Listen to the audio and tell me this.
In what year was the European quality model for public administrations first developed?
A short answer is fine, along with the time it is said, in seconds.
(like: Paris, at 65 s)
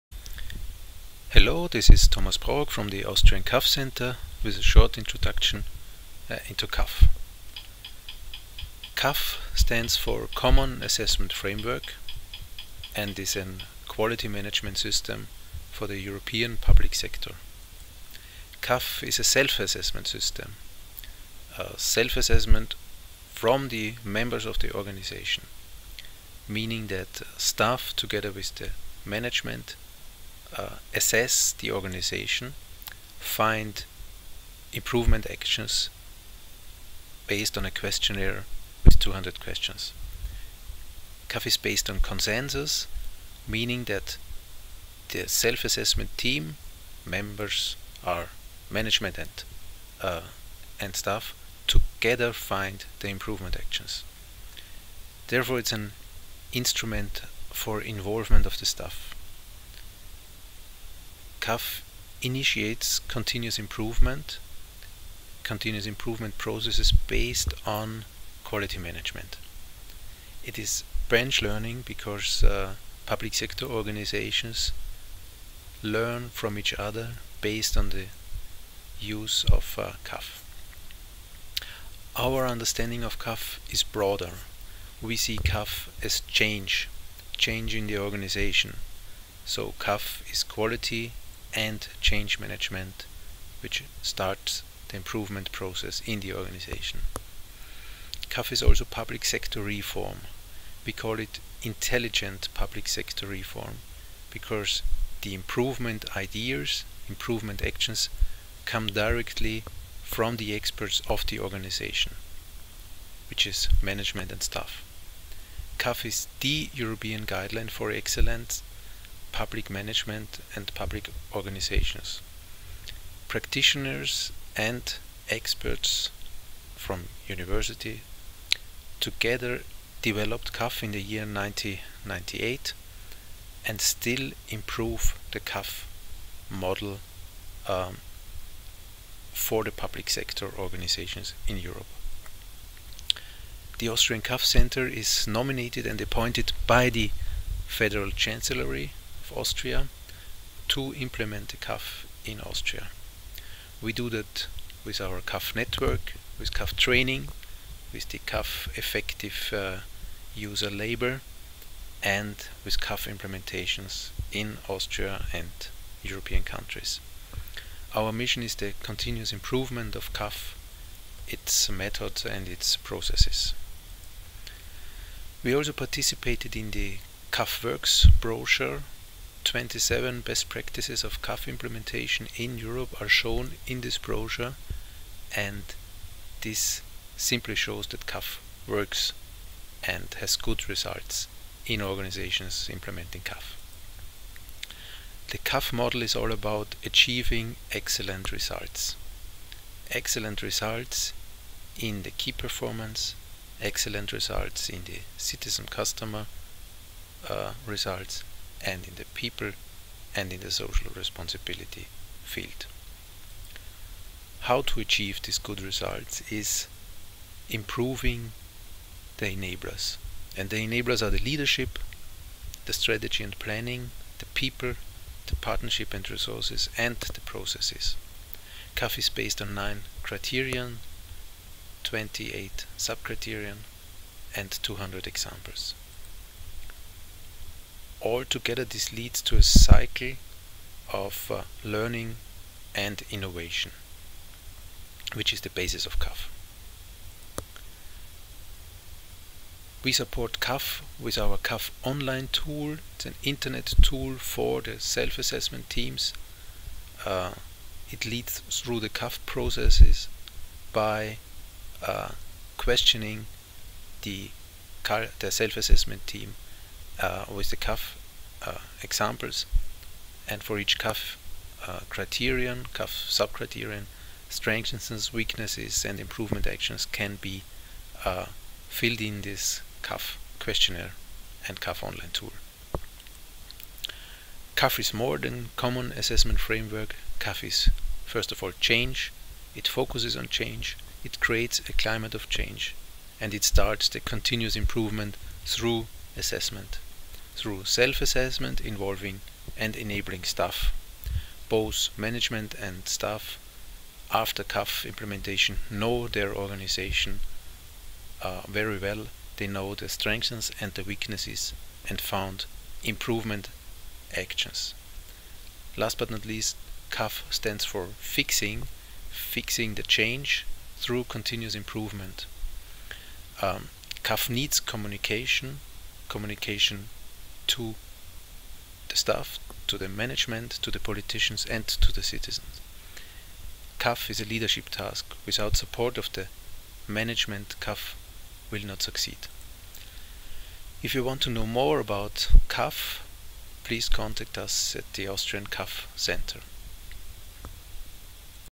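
1998, at 131 s.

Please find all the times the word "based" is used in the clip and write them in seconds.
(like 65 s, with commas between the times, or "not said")
37 s, 41 s, 66 s, 77 s, 229 s.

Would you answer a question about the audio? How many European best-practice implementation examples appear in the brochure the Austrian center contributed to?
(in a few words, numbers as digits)
27.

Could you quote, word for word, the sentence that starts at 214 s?
How to achieve these good results is improving the enablers.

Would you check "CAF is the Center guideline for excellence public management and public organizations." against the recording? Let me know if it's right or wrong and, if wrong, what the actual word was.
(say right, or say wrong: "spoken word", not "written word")
wrong: "European", not "Center".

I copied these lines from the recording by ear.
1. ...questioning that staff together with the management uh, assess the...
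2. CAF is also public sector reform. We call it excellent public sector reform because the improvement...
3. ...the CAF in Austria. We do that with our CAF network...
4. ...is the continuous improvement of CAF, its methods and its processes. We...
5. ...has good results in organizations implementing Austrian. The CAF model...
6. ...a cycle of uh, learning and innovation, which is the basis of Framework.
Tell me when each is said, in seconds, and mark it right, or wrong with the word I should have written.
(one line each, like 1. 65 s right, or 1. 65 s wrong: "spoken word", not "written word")
1. 26 s wrong: "meaning", not "questioning"
2. 98 s wrong: "intelligent", not "excellent"
3. 151 s right
4. 168 s right
5. 190 s wrong: "CAF", not "Austrian"
6. 239 s wrong: "CAF", not "Framework".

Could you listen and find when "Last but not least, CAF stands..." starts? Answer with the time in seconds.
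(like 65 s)
315 s.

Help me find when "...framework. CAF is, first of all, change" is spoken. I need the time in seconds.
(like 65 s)
286 s.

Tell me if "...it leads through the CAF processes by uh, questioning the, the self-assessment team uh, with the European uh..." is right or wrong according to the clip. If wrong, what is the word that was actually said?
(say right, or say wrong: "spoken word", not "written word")
wrong: "CAF", not "European".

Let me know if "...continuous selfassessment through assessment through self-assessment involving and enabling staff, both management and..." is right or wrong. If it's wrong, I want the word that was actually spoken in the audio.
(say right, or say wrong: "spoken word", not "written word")
wrong: "improvement", not "selfassessment".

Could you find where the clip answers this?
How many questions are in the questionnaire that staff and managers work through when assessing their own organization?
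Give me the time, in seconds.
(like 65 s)
38 s.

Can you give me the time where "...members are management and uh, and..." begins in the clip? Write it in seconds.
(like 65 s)
47 s.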